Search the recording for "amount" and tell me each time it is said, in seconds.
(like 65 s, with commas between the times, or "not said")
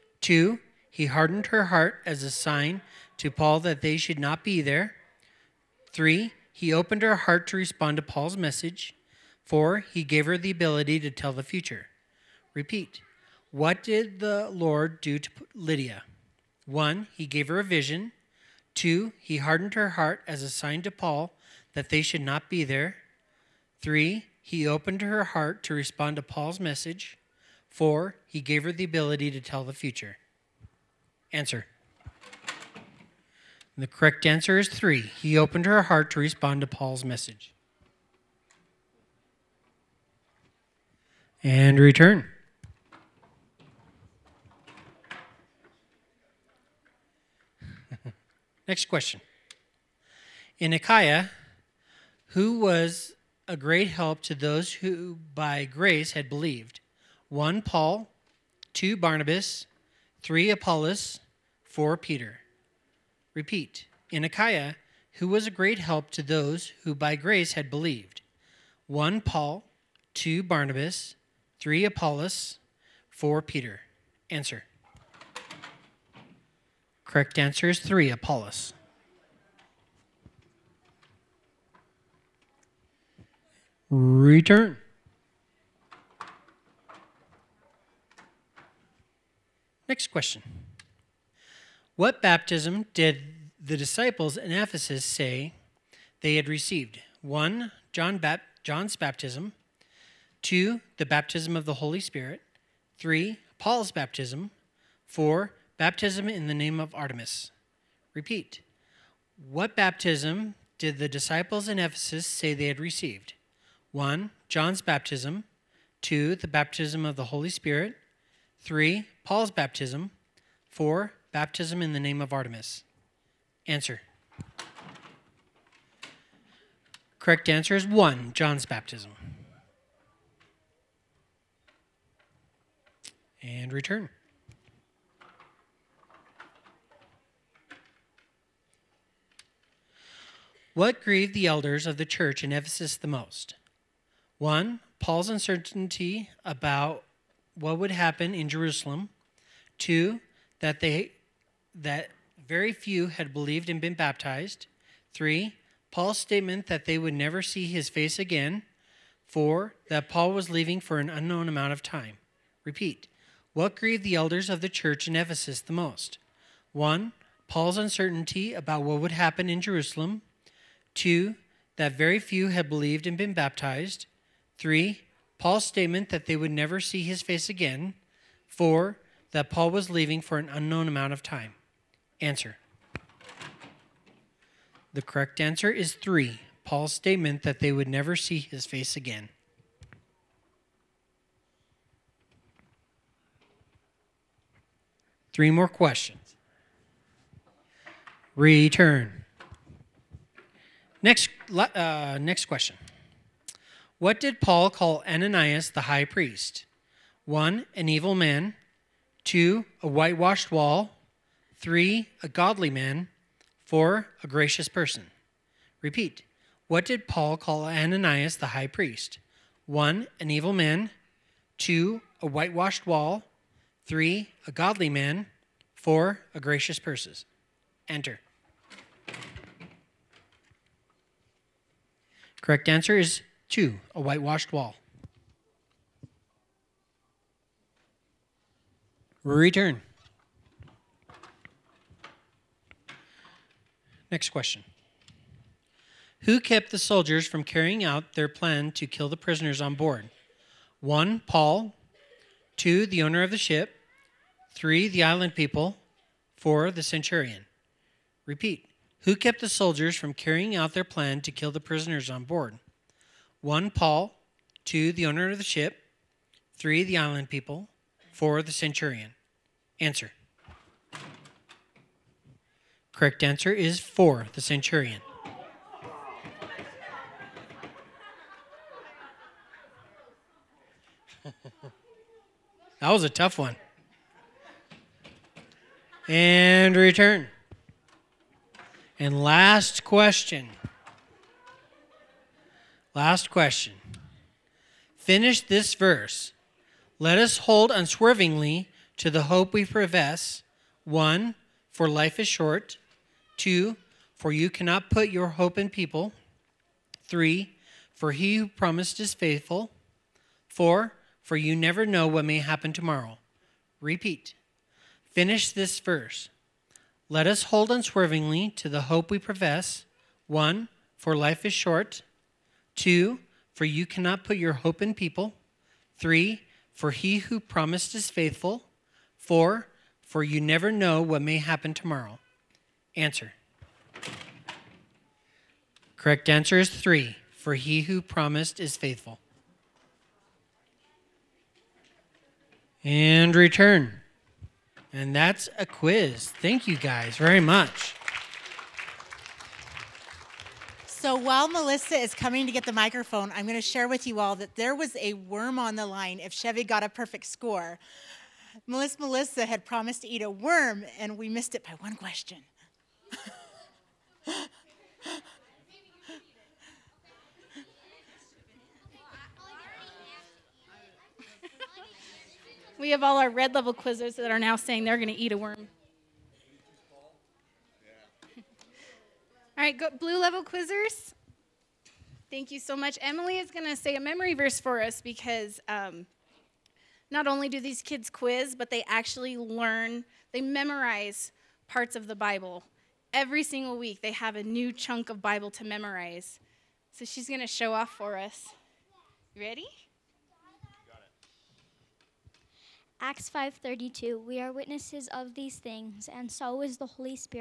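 161 s, 180 s.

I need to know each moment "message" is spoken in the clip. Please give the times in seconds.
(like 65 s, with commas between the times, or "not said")
8 s, 26 s, 37 s.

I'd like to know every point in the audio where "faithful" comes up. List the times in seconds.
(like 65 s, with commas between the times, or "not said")
309 s, 328 s, 338 s.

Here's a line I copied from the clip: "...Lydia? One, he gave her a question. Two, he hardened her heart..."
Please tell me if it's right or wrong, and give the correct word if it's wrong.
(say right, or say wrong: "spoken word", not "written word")
wrong: "vision", not "question".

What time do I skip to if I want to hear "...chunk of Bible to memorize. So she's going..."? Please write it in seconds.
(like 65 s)
394 s.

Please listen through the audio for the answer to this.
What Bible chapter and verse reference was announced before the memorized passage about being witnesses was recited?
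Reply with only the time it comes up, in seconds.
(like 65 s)
403 s.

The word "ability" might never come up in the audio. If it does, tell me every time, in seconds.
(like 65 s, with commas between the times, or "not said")
10 s, 28 s.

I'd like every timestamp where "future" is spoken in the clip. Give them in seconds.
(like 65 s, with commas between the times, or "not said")
11 s, 29 s.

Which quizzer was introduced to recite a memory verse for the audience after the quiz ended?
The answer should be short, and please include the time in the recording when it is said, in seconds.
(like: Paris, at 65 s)
Emily, at 383 s.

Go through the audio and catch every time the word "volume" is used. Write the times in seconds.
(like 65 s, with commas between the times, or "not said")
not said.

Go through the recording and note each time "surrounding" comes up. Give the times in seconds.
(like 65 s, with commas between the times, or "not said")
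not said.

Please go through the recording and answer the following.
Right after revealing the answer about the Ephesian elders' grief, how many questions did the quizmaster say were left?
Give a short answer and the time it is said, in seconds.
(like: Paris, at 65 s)
3, at 195 s.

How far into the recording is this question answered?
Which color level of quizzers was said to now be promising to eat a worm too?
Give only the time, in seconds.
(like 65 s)
373 s.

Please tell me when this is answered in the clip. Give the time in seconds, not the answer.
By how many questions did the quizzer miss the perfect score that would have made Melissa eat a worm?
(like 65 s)
361 s.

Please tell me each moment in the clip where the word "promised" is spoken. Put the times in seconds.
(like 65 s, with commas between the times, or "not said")
308 s, 327 s, 337 s, 359 s.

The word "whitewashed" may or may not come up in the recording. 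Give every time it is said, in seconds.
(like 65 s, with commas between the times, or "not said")
209 s, 222 s, 233 s.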